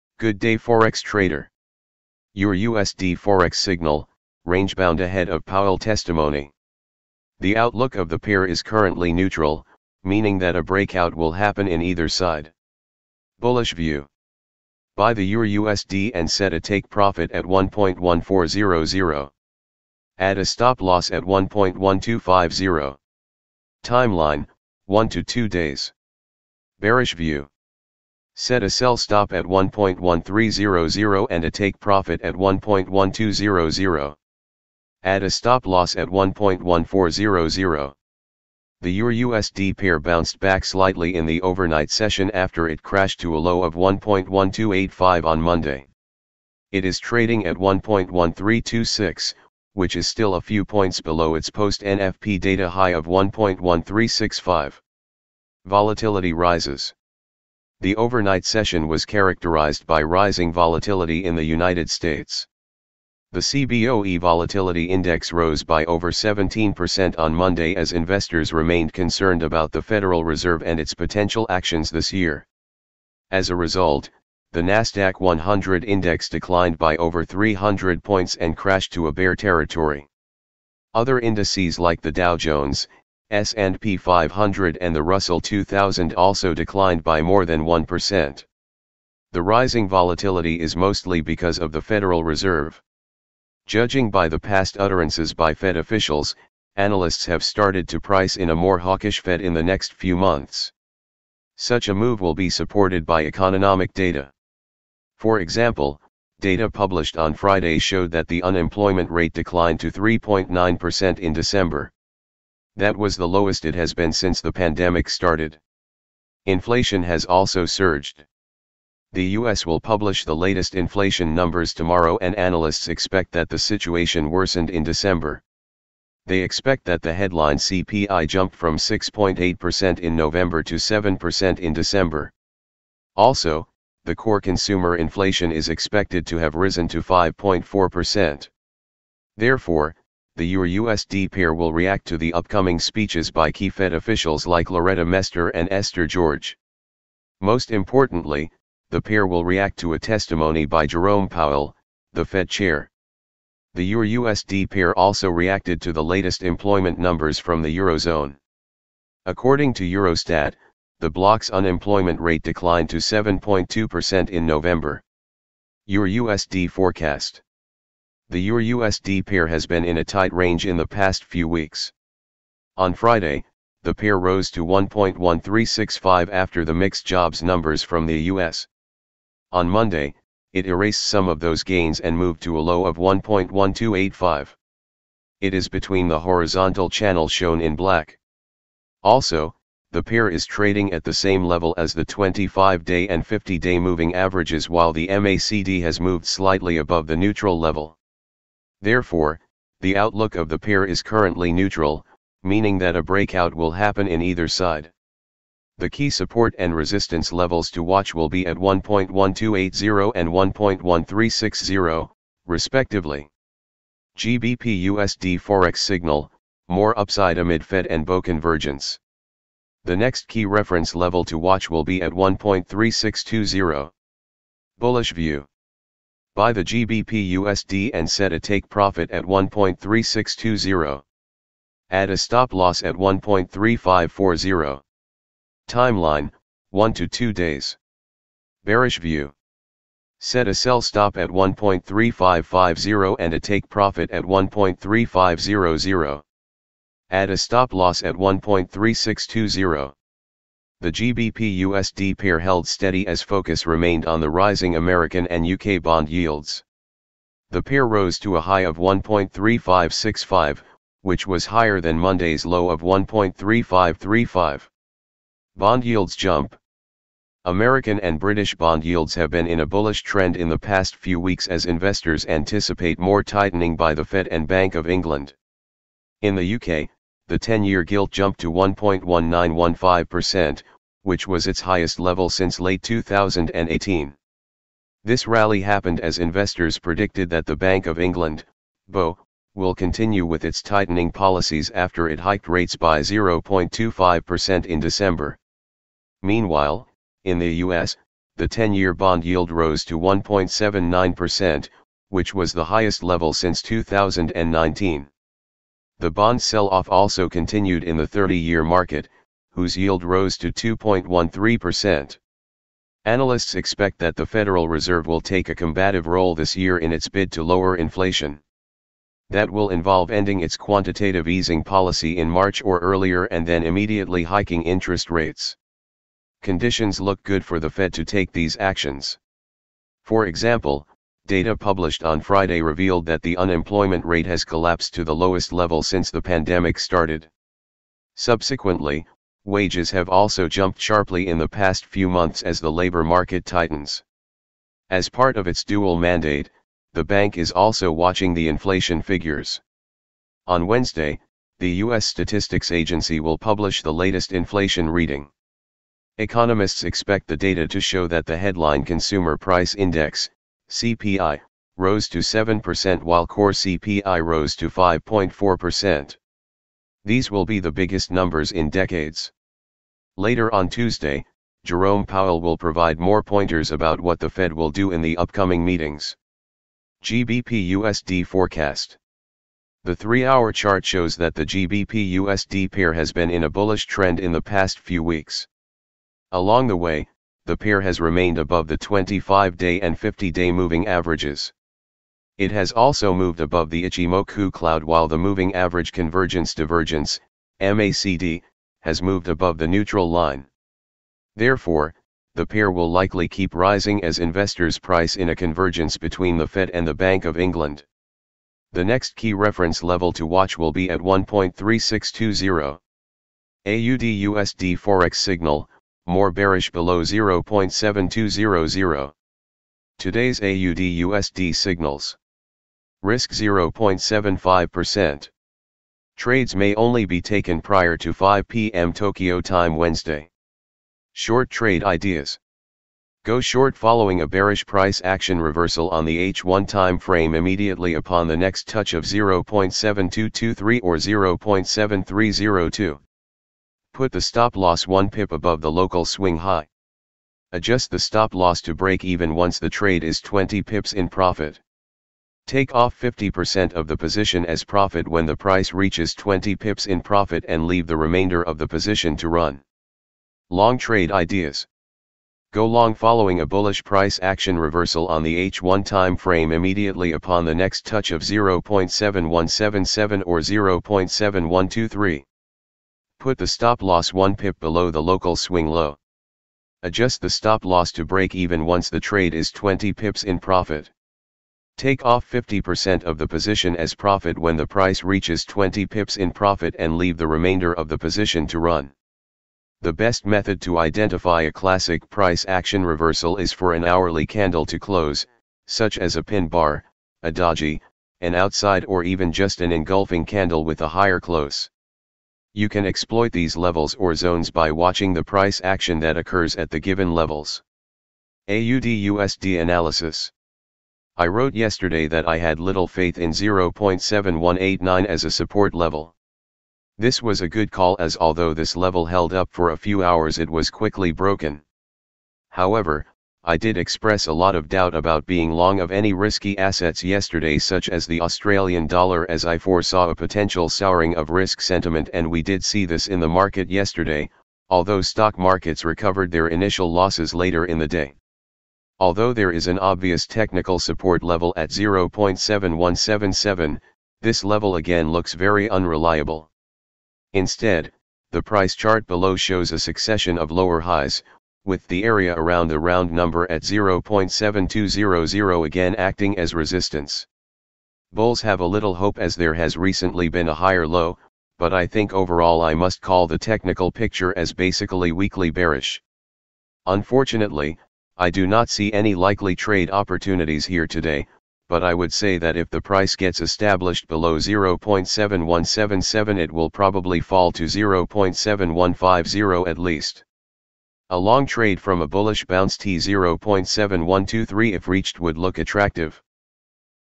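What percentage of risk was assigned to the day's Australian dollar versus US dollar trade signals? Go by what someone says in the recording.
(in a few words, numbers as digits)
0.75%.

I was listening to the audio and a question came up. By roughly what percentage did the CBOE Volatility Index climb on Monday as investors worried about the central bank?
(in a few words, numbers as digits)
17%.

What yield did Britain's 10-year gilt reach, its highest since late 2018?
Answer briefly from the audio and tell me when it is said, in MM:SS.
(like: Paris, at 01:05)
1.1915%, at 04:38.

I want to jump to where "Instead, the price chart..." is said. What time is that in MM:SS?
09:07.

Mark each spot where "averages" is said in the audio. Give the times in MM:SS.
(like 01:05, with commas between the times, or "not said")
03:14, 06:30, 06:35.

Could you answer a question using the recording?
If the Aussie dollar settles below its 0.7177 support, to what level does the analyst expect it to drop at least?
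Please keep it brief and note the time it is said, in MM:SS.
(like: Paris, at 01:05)
0.7150, at 09:37.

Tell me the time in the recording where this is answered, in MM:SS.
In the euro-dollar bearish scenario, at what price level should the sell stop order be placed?
00:29.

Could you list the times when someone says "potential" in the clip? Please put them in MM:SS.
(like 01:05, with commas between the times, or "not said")
01:10, 08:50.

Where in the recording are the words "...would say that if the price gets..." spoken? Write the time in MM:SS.
09:31.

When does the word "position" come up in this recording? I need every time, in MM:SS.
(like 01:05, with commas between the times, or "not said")
07:33, 07:38, 08:03, 08:07.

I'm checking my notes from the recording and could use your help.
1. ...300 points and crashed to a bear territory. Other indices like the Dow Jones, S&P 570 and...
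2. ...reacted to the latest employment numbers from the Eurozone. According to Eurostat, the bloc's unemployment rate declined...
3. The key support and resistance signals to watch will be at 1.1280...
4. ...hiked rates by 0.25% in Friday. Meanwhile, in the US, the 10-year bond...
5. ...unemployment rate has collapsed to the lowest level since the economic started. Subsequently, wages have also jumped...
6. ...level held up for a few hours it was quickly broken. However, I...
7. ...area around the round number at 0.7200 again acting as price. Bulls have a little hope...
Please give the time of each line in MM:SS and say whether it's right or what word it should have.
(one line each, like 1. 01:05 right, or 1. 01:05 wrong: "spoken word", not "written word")
1. 01:17 wrong: "500", not "570"
2. 02:35 right
3. 03:25 wrong: "levels", not "signals"
4. 04:52 wrong: "December", not "Friday"
5. 05:33 wrong: "pandemic", not "economic"
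6. 08:38 right
7. 09:12 wrong: "resistance", not "price".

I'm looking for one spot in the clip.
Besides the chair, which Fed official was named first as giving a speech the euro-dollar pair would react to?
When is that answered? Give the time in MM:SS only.
02:24.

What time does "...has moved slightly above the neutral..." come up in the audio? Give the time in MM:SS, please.
03:15.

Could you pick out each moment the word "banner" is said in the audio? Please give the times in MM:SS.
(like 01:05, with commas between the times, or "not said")
not said.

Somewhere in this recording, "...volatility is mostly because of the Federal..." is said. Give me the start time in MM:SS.
01:29.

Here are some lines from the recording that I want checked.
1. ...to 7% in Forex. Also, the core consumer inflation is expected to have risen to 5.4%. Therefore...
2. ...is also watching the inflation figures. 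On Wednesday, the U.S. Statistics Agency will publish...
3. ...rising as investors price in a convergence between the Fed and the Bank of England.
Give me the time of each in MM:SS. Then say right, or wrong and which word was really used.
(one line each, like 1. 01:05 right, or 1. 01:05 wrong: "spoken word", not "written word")
1. 02:10 wrong: "December", not "Forex"
2. 05:47 right
3. 06:43 right.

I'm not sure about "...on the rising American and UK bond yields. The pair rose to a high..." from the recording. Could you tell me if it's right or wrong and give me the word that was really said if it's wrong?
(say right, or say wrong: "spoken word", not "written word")
right.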